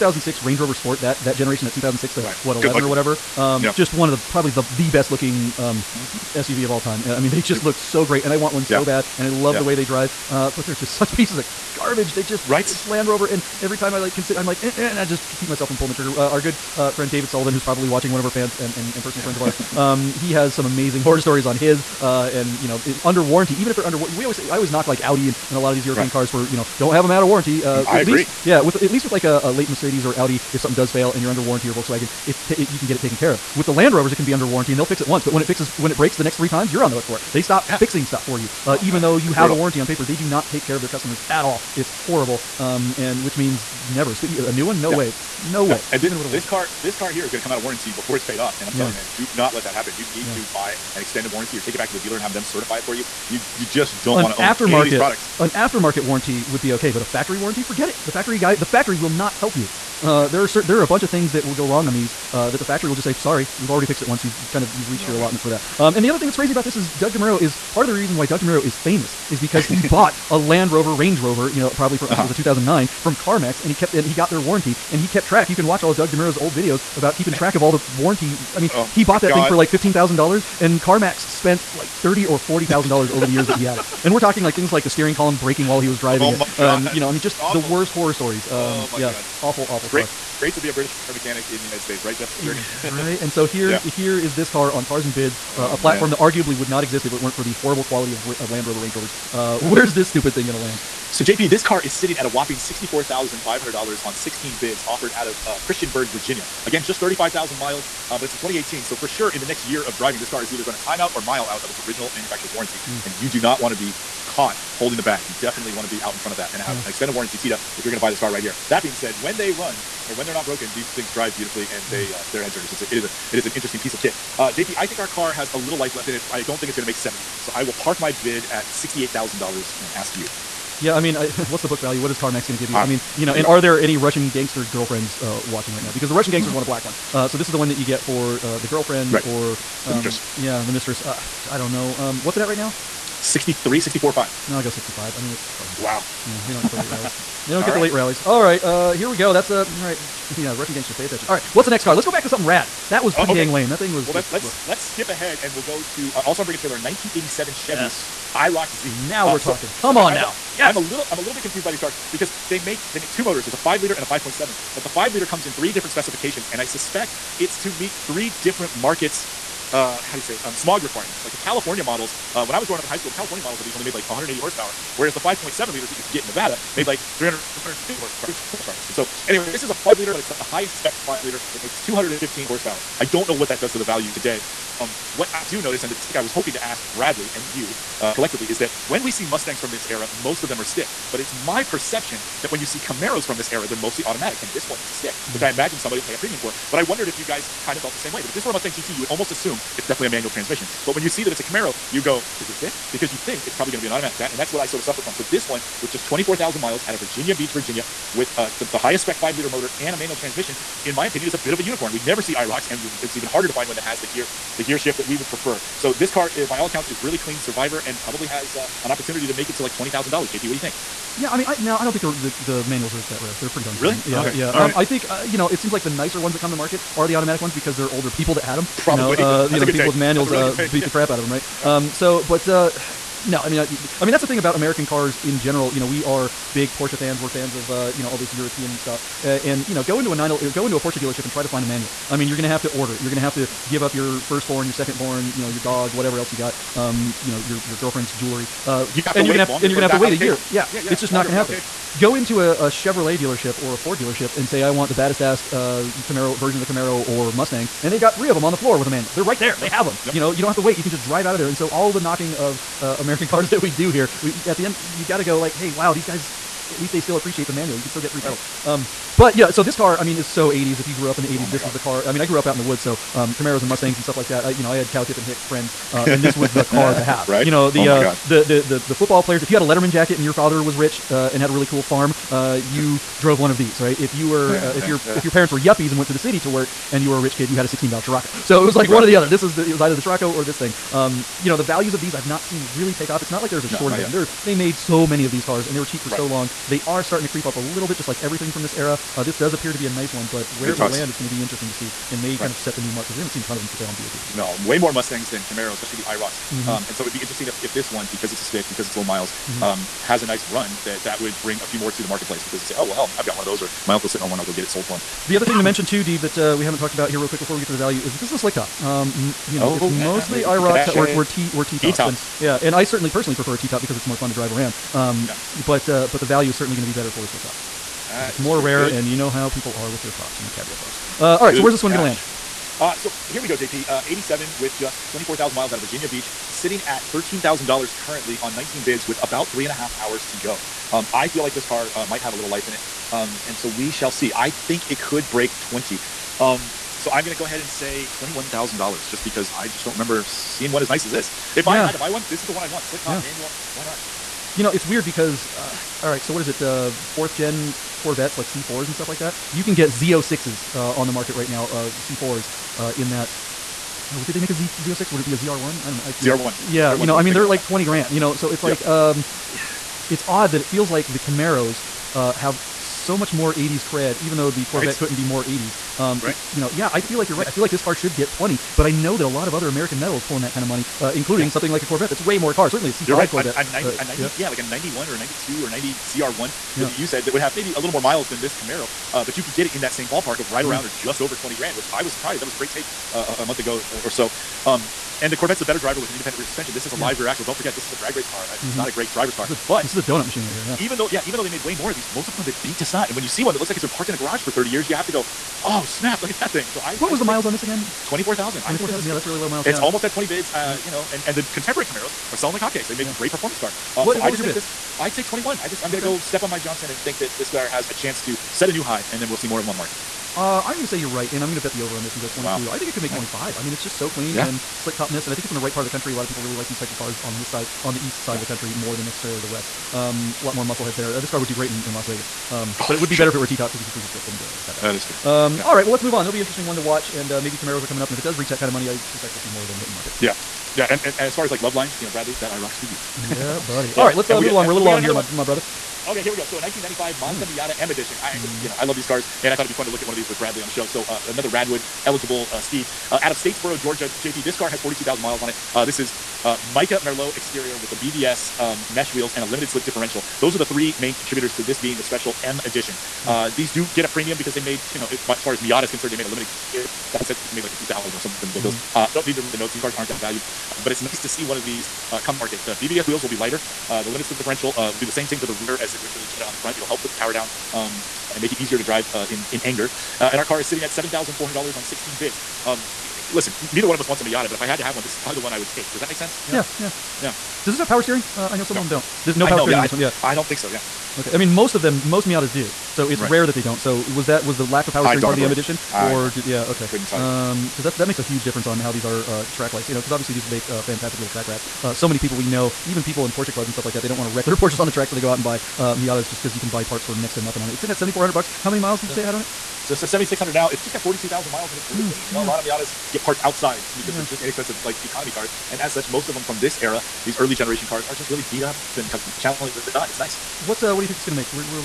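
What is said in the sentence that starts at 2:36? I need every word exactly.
Uh, also, I'm bringing a trailer in 1987 Chevy yes.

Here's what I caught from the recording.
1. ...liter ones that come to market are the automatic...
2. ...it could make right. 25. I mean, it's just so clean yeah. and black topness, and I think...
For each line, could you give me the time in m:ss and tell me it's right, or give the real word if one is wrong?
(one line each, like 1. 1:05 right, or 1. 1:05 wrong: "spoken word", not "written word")
1. 3:45 wrong: "nicer", not "liter"
2. 7:02 wrong: "slick", not "black".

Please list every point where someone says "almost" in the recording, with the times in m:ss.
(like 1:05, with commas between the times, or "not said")
3:19, 6:49.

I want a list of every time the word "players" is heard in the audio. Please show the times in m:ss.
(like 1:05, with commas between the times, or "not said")
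4:39.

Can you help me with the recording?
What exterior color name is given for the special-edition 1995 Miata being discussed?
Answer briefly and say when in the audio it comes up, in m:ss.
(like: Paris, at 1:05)
Mica Merlot, at 7:36.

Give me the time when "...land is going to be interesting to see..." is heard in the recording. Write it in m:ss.
5:00.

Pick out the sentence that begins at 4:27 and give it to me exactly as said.
You can still get three right.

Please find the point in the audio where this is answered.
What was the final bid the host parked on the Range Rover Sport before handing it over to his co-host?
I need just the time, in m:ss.
2:08.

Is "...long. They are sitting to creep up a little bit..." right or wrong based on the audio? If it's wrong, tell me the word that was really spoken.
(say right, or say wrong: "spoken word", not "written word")
wrong: "starting", not "sitting".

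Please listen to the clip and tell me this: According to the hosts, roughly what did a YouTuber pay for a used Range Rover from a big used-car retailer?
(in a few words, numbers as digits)
$15,000.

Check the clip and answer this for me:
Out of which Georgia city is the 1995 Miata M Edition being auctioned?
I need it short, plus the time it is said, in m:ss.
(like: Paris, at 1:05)
Statesboro, at 7:33.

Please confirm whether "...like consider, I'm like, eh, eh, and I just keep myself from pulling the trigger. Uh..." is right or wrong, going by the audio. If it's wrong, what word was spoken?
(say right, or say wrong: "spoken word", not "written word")
right.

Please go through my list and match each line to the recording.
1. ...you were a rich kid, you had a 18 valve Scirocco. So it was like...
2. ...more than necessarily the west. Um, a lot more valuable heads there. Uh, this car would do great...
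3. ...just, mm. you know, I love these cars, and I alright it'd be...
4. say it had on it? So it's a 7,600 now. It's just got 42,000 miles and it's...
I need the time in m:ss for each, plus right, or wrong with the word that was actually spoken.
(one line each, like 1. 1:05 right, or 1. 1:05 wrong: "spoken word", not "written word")
1. 4:47 wrong: "16", not "18"
2. 7:08 wrong: "muscle", not "valuable"
3. 7:28 wrong: "thought", not "alright"
4. 8:29 right.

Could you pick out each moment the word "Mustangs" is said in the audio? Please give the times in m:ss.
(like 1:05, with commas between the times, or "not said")
3:09, 3:18, 4:17, 4:33, 5:04.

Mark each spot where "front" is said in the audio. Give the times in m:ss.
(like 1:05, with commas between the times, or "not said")
1:56, 7:56.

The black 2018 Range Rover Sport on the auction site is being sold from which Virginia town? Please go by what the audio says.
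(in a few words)
Christiansburg.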